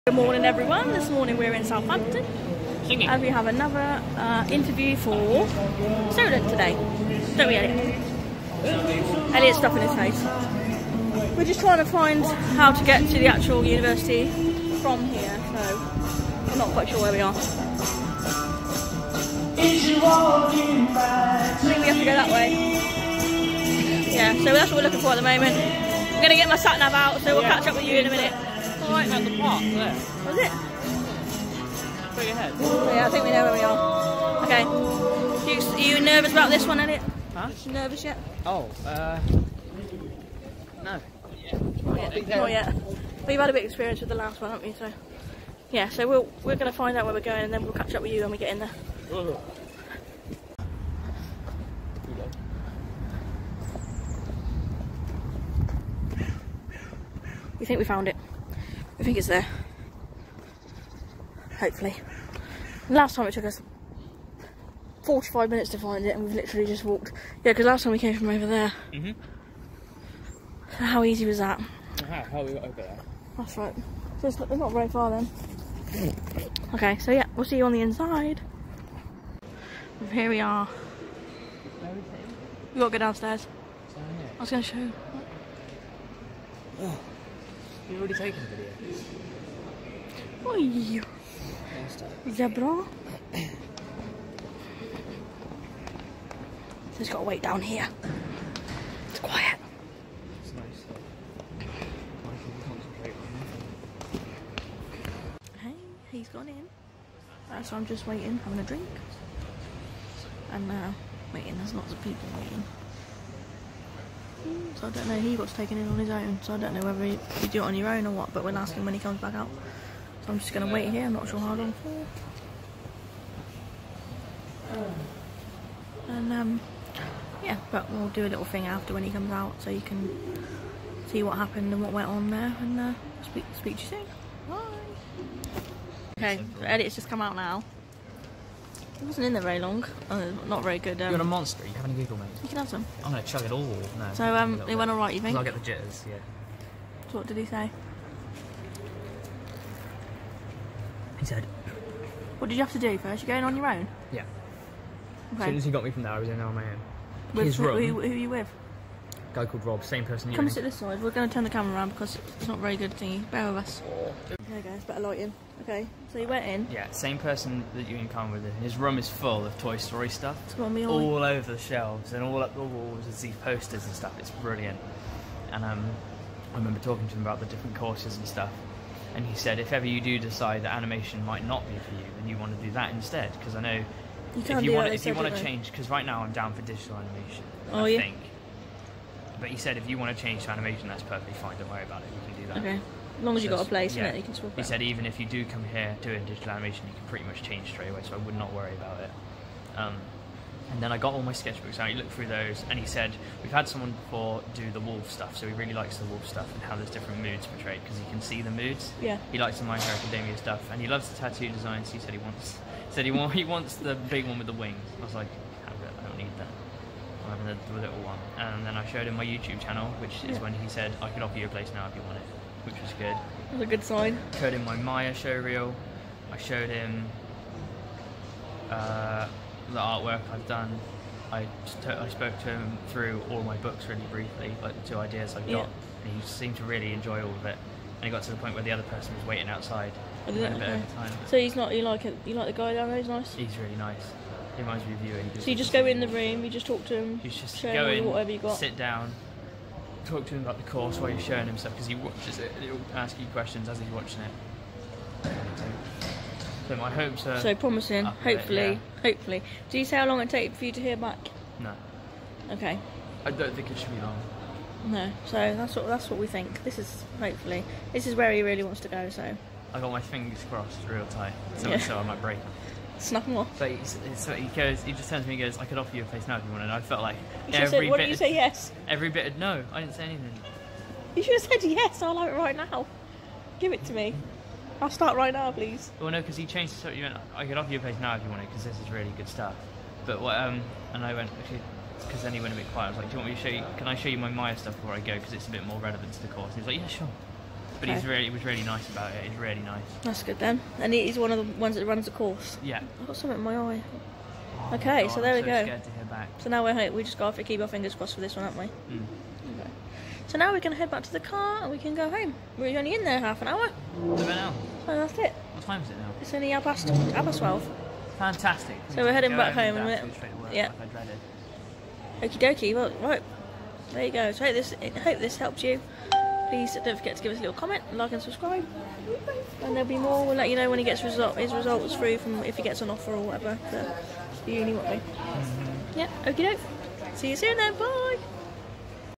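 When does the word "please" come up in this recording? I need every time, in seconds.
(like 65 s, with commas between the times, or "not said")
285 s, 326 s.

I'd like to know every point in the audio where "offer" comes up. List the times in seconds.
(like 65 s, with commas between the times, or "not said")
221 s, 275 s, 287 s, 332 s.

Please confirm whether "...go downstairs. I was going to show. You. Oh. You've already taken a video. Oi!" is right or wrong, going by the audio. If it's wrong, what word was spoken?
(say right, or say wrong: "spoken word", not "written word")
right.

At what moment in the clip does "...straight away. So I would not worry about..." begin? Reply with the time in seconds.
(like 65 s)
197 s.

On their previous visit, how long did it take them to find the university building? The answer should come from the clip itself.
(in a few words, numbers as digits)
45 minutes.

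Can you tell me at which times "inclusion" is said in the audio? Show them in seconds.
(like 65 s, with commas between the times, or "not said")
not said.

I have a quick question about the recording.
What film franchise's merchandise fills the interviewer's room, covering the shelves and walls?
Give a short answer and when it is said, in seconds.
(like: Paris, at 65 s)
Toy Story, at 169 s.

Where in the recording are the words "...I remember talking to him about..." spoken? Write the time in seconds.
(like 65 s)
176 s.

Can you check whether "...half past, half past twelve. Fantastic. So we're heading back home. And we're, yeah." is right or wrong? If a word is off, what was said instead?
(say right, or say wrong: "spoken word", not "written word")
right.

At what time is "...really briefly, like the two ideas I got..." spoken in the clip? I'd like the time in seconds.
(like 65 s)
233 s.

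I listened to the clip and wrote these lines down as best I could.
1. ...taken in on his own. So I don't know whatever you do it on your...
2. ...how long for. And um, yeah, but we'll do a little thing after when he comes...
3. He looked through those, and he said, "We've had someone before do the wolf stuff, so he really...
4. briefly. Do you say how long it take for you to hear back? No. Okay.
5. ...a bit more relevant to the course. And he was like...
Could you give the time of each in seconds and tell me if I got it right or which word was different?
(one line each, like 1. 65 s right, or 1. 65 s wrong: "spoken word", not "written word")
1. 115 s wrong: "whether", not "whatever"
2. 121 s right
3. 201 s right
4. 259 s wrong: "hopefully", not "briefly"
5. 295 s right.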